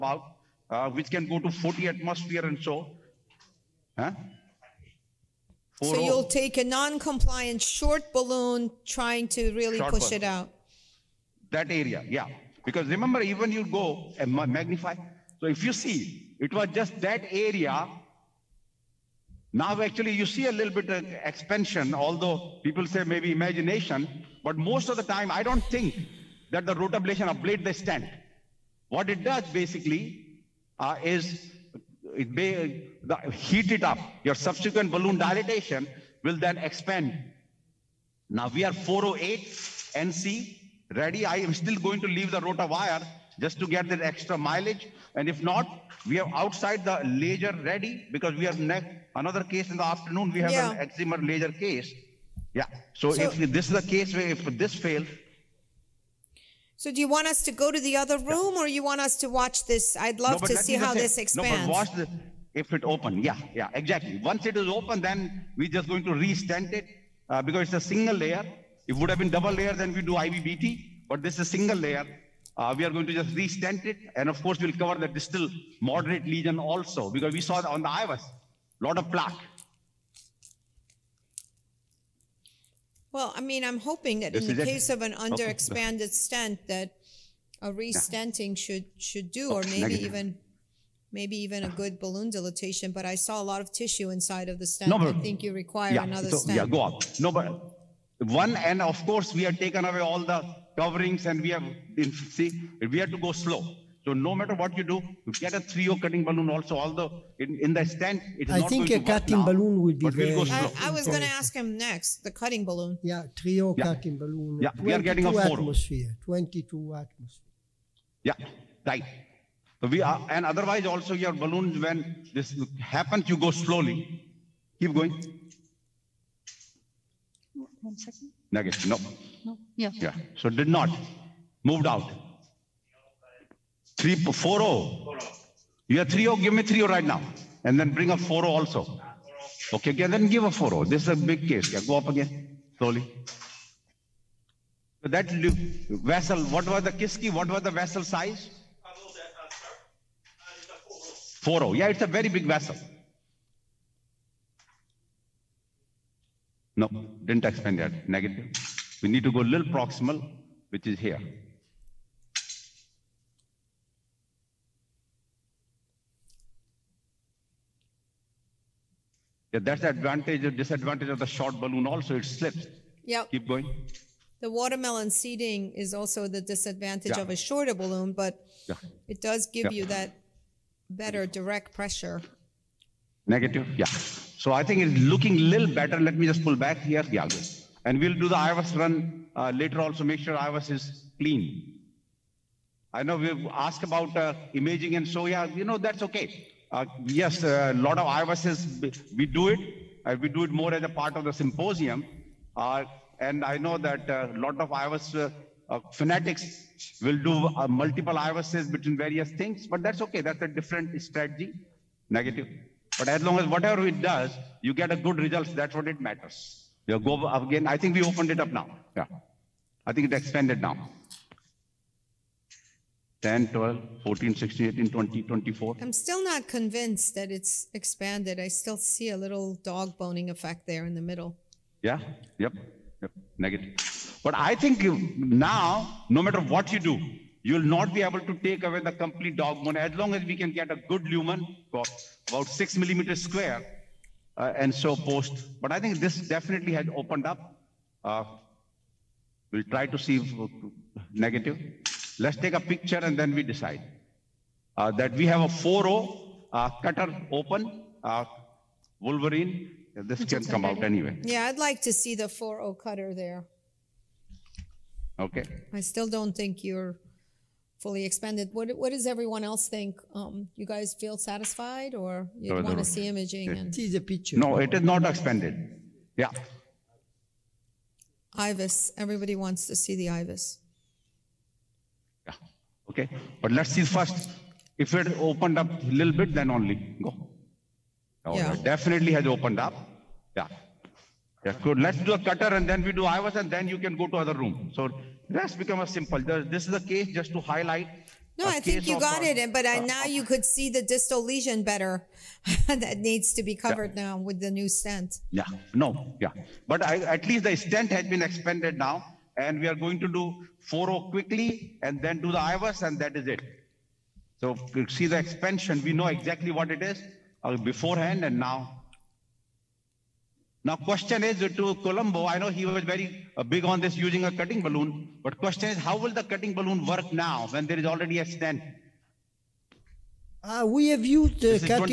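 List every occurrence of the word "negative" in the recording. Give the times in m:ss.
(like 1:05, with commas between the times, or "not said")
1:29, 2:08, 2:38, 3:03, 3:32, 3:53, 4:11.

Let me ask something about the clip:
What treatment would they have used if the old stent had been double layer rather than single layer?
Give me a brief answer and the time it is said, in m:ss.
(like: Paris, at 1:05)
IVBT, at 1:10.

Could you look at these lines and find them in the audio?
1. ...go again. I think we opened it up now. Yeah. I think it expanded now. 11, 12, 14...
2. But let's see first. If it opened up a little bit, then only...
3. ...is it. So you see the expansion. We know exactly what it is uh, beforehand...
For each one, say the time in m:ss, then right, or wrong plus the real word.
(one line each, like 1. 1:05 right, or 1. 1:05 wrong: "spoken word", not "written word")
1. 3:36 wrong: "10", not "11"
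2. 4:43 right
3. 5:13 right.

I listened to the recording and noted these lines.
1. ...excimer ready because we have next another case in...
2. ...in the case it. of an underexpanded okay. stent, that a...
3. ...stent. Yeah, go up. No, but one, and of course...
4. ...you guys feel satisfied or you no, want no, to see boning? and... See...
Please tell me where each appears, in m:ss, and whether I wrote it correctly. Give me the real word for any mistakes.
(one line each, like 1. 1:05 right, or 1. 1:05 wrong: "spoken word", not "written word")
1. 0:47 wrong: "laser", not "excimer"
2. 1:24 right
3. 1:36 right
4. 4:30 wrong: "imaging", not "boning".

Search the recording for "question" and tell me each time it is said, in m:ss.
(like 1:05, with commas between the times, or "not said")
5:20, 5:25.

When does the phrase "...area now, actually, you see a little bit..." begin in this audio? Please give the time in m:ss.
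0:17.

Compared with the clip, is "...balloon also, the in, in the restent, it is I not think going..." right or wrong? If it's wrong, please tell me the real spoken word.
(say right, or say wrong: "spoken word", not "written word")
wrong: "stent", not "restent".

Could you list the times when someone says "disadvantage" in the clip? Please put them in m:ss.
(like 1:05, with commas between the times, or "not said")
2:50, 2:56.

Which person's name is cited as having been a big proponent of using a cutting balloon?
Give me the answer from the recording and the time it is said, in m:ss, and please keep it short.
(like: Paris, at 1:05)
Colombo, at 5:21.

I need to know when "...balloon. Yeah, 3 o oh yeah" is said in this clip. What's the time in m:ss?
1:52.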